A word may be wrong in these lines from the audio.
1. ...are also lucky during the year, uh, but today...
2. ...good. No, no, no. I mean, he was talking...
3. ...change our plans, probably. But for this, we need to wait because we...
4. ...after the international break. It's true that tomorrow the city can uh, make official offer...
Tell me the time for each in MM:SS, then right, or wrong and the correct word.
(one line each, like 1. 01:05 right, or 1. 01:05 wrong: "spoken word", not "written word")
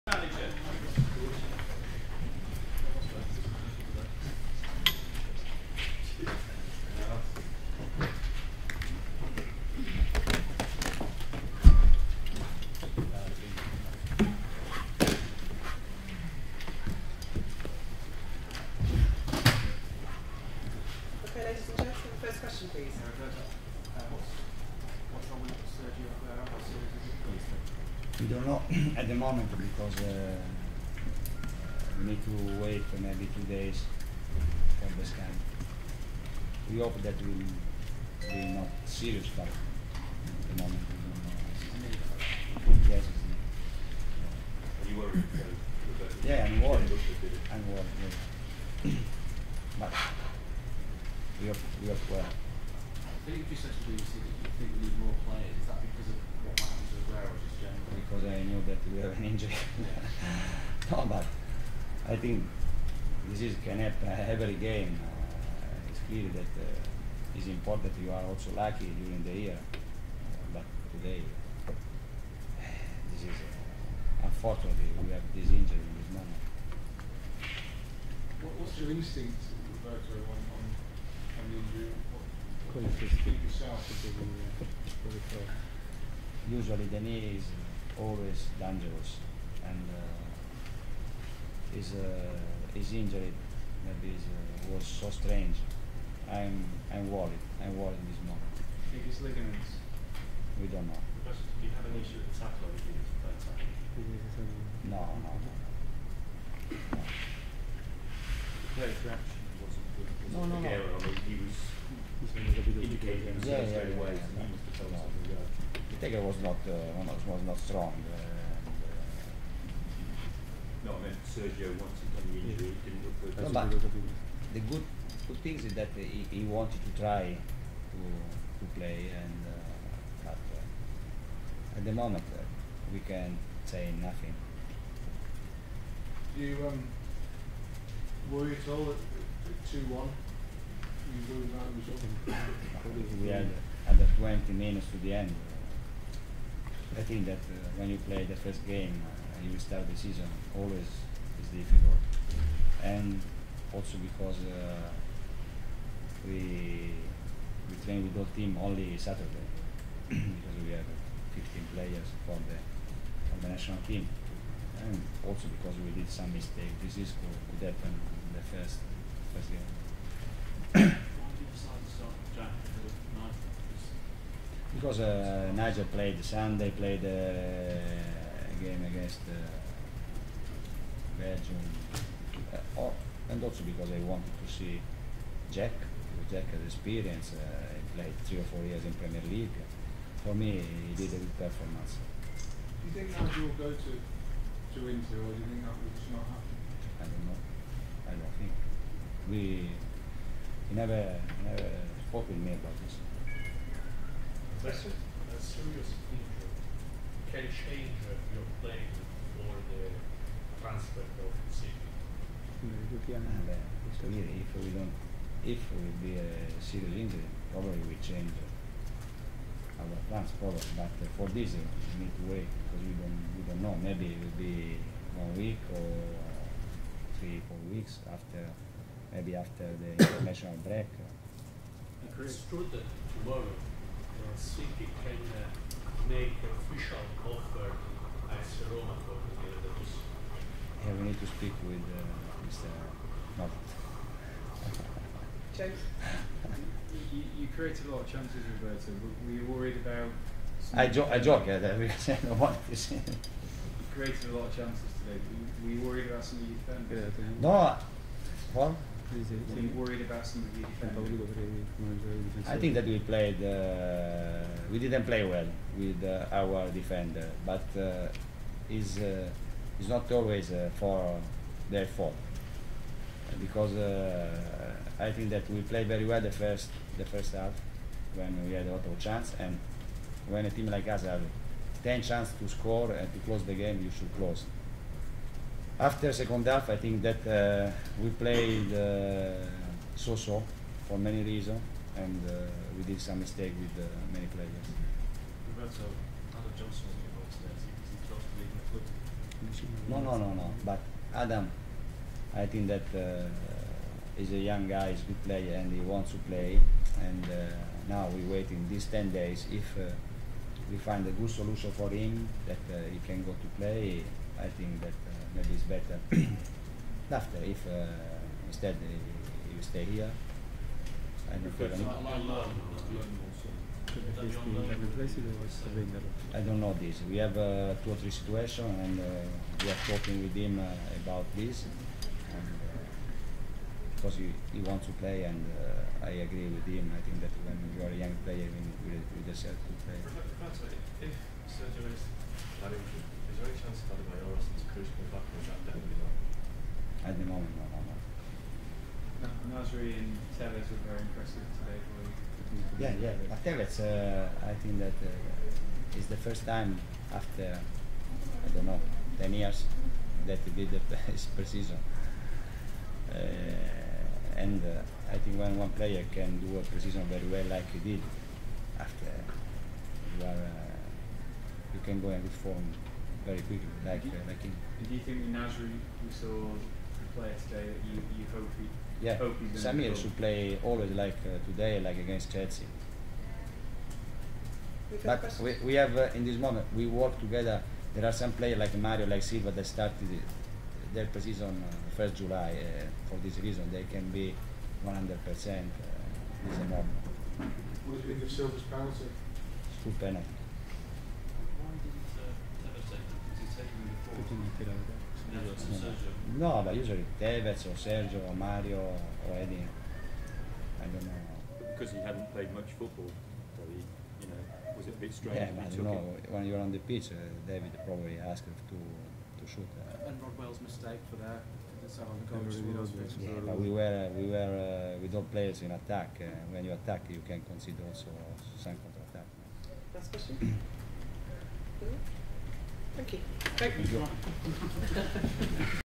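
1. 01:08 right
2. 01:49 wrong: "indicating", not "talking"
3. 03:38 right
4. 03:49 right.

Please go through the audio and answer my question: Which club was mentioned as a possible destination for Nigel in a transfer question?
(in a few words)
Inter.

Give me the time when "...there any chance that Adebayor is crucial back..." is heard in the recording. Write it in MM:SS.
05:43.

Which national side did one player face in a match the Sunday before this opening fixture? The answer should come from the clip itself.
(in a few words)
Belgium.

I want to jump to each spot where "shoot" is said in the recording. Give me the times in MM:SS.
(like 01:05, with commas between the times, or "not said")
06:59.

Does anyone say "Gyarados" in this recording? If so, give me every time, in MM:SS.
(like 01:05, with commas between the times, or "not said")
03:59.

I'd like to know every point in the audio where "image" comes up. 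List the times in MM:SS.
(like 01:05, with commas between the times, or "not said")
not said.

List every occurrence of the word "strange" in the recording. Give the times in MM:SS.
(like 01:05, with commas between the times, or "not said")
01:35, 06:55.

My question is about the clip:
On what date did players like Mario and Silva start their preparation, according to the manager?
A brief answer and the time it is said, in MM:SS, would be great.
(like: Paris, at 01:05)
1 July, at 06:31.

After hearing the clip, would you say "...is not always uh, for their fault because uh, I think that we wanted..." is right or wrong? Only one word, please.
wrong.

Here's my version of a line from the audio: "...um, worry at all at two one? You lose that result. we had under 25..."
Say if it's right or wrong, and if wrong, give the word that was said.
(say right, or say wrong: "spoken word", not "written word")
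wrong: "20", not "25".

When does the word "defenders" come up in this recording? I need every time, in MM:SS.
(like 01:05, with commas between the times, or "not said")
04:17, 04:26.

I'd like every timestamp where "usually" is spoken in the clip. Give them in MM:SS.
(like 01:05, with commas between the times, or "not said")
01:26, 06:46.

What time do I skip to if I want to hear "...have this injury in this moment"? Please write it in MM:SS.
01:15.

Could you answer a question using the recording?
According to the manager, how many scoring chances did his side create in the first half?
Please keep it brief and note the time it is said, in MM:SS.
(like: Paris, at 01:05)
10, at 04:41.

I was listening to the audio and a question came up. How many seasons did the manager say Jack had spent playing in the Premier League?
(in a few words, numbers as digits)
three or four.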